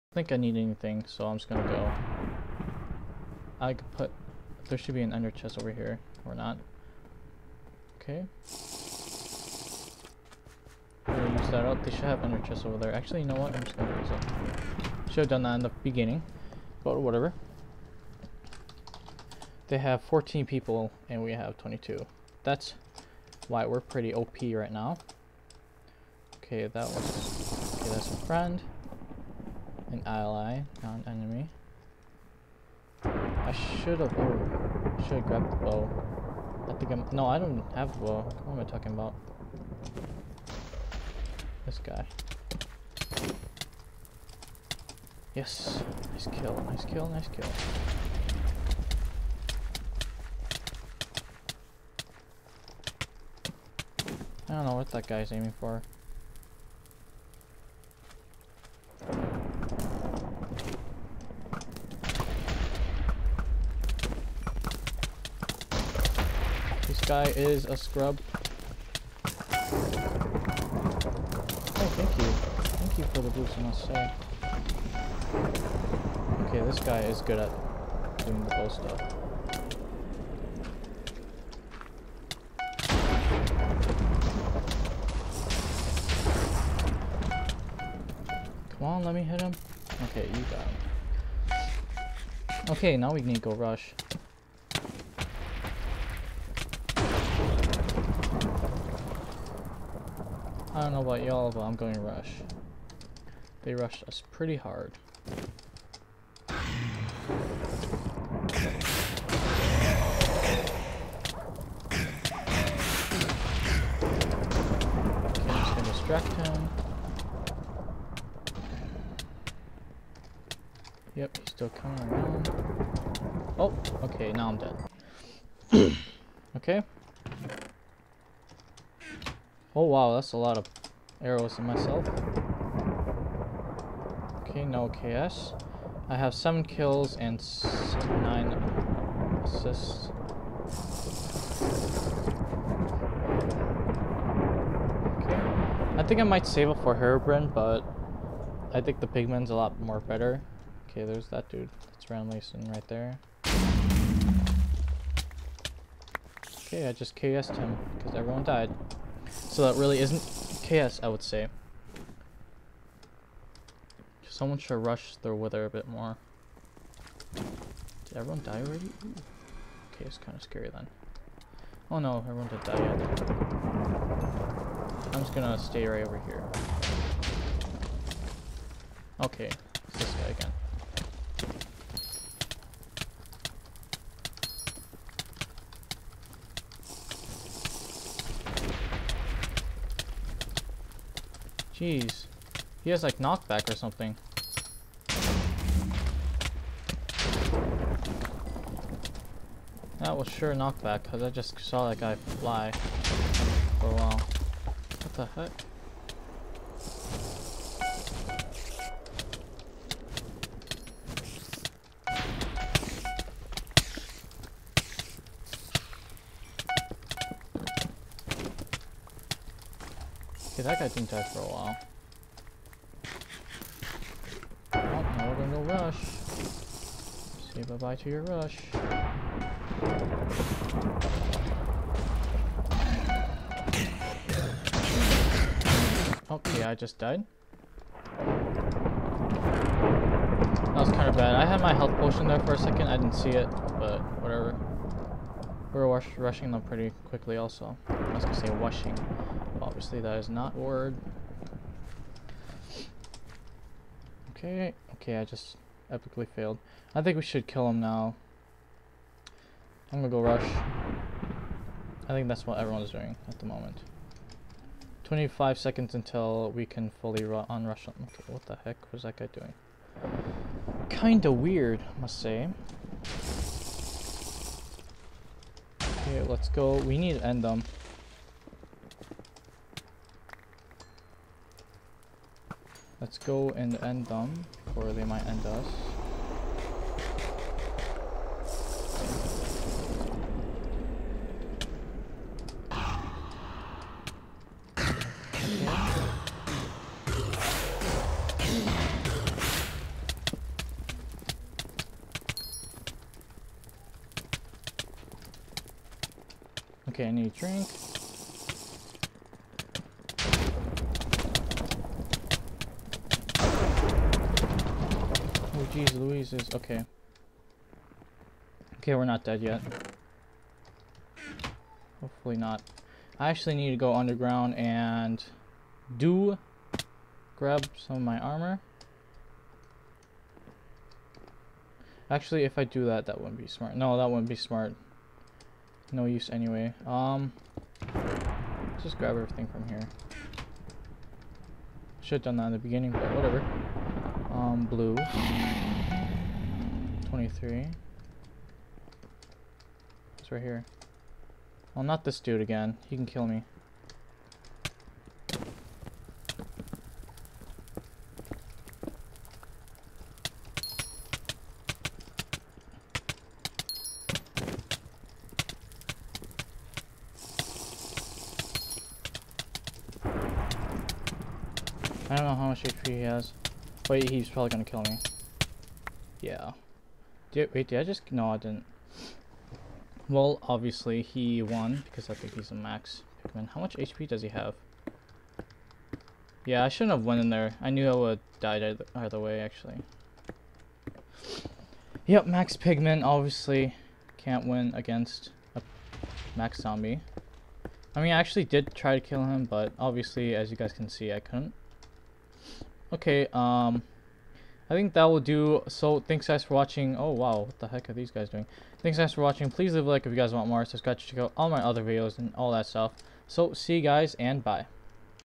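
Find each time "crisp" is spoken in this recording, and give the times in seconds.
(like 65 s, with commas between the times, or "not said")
not said.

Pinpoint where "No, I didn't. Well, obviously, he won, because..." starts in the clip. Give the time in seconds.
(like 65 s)
378 s.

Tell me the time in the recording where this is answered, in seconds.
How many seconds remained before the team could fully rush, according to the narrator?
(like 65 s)
265 s.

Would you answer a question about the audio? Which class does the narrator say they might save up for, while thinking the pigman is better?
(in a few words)
Herobrine.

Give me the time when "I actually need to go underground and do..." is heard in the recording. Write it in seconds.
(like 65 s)
323 s.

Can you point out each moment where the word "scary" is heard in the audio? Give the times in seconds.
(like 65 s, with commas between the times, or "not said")
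170 s.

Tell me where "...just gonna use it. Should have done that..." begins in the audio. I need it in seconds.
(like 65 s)
13 s.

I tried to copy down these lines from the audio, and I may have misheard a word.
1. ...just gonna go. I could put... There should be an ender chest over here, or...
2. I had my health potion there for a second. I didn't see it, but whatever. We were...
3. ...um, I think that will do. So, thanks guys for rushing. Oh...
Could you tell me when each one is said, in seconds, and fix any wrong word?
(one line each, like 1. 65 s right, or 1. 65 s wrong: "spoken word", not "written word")
1. 1 s right
2. 241 s right
3. 403 s wrong: "watching", not "rushing".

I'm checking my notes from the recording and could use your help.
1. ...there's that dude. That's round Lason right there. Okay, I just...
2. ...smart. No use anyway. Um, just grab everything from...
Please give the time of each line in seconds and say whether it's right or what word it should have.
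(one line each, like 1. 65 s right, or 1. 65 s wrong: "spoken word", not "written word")
1. 151 s right
2. 334 s right.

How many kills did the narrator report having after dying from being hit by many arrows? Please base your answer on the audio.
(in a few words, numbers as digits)
7.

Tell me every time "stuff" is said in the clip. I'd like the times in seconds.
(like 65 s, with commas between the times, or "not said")
78 s, 412 s.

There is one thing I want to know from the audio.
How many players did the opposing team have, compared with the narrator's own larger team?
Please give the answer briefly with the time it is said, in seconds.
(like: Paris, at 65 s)
14, at 20 s.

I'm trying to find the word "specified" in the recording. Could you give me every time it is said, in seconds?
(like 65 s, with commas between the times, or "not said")
not said.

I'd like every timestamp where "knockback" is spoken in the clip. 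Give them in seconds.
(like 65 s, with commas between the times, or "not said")
193 s, 200 s.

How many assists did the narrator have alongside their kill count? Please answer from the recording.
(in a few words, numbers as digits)
9.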